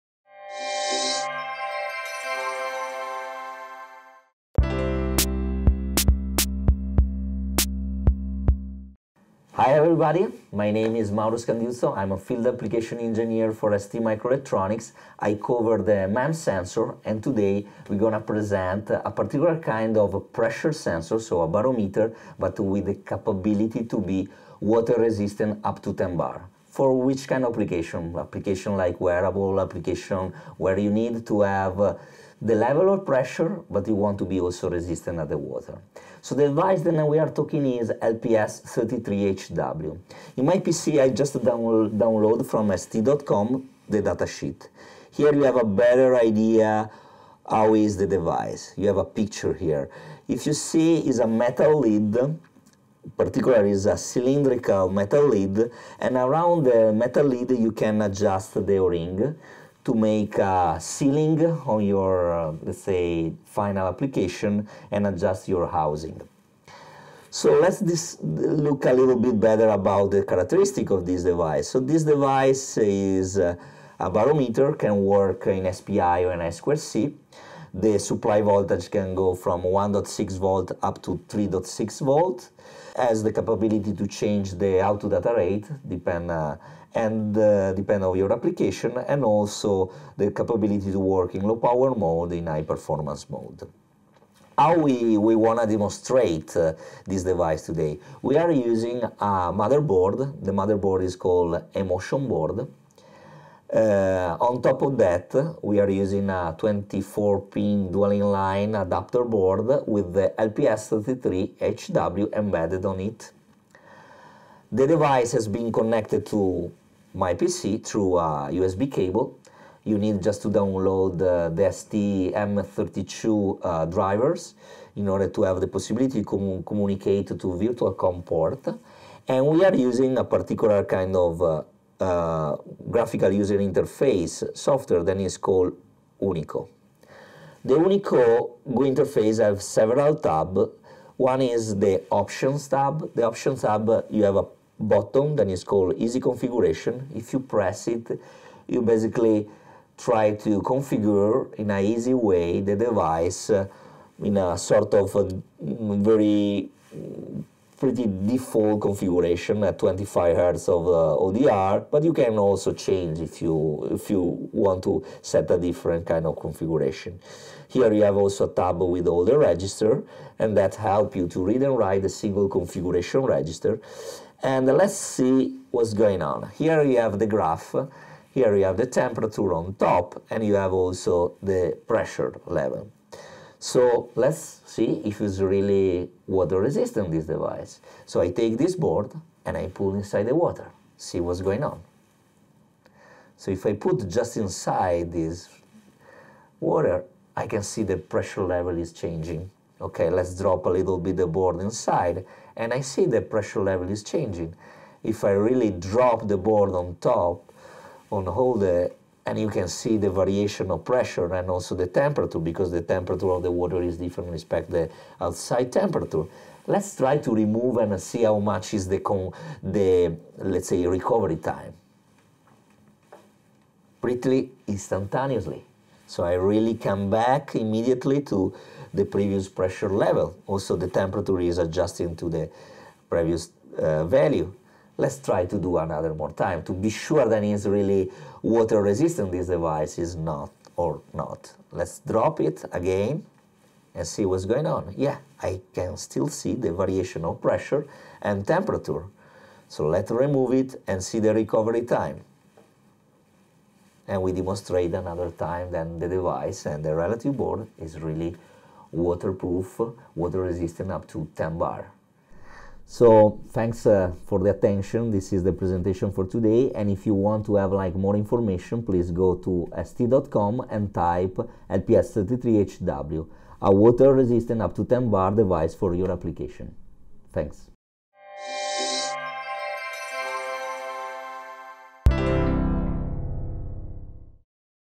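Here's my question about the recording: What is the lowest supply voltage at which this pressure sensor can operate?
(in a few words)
1.6 volts.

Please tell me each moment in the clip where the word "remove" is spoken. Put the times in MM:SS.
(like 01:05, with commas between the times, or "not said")
03:37, 04:10.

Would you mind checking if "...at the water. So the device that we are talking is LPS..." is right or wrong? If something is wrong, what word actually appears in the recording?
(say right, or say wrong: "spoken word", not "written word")
right.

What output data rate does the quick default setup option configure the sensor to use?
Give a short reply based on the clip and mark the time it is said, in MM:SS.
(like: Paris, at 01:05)
25 Hz, at 02:39.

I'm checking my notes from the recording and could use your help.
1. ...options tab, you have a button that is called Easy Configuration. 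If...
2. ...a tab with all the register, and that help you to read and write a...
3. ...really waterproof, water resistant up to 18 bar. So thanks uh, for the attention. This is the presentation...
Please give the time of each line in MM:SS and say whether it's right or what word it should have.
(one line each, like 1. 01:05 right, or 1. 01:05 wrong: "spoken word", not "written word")
1. 02:23 right
2. 02:48 right
3. 04:17 wrong: "10", not "18".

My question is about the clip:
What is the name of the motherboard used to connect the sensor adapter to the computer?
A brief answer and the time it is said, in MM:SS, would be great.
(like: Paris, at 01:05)
Emotion Board, at 01:41.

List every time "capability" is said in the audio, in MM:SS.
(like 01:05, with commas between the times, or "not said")
00:22, 01:23, 01:30.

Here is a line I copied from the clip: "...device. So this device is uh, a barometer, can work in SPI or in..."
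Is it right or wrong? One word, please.
right.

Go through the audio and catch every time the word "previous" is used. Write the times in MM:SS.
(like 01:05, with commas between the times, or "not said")
03:49, 03:53.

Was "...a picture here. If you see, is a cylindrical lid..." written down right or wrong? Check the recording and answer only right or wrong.
wrong.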